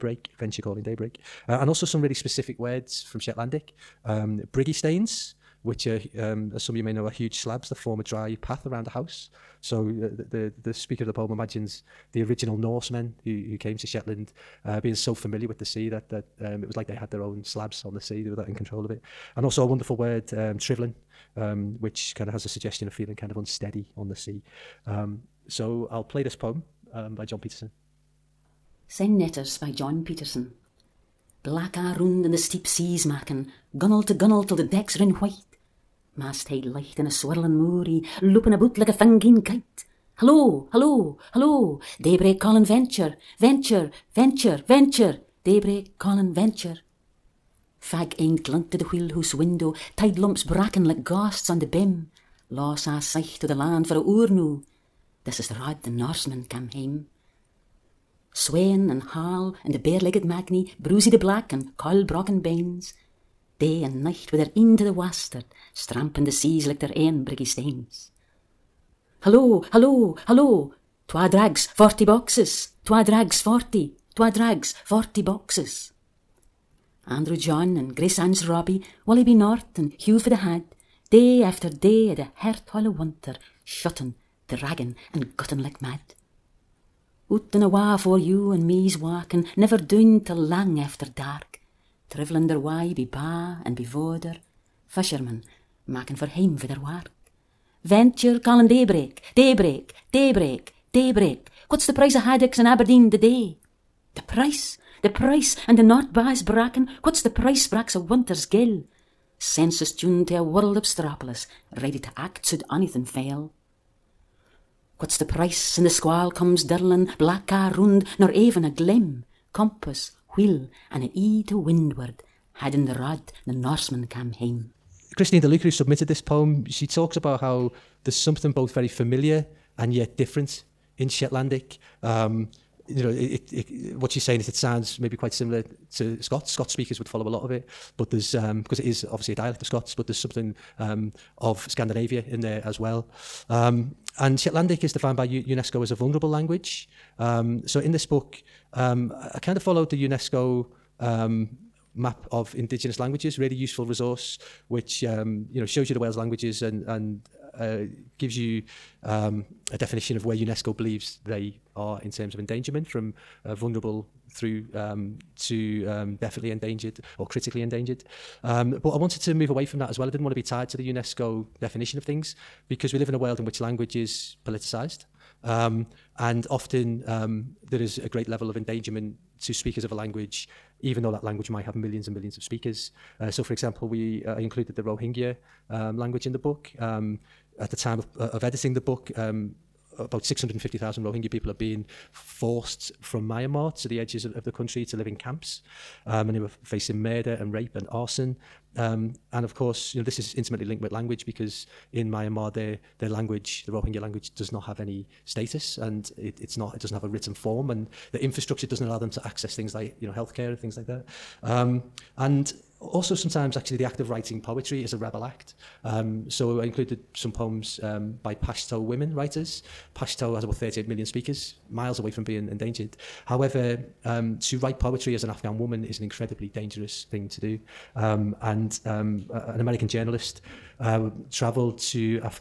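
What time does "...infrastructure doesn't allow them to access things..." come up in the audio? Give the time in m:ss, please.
3:28.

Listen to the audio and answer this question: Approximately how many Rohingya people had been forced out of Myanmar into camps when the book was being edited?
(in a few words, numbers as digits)
650,000.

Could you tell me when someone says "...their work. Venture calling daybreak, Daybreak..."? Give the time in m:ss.
1:36.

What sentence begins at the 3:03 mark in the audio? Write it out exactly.
Uh, so, for example, we uh, I included the Rohingya um, language in the book.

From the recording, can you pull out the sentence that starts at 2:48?
Um, but I wanted to move away from that as well.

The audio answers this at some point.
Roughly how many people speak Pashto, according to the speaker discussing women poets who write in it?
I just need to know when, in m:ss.
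3:40.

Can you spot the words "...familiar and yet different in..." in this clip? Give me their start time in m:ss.
2:08.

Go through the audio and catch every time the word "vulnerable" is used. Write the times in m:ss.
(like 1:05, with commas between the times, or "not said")
2:25, 2:43.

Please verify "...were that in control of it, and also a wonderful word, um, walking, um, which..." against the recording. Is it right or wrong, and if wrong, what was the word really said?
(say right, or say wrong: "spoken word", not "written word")
wrong: "trivelling", not "walking".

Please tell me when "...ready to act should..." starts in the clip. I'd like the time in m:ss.
1:51.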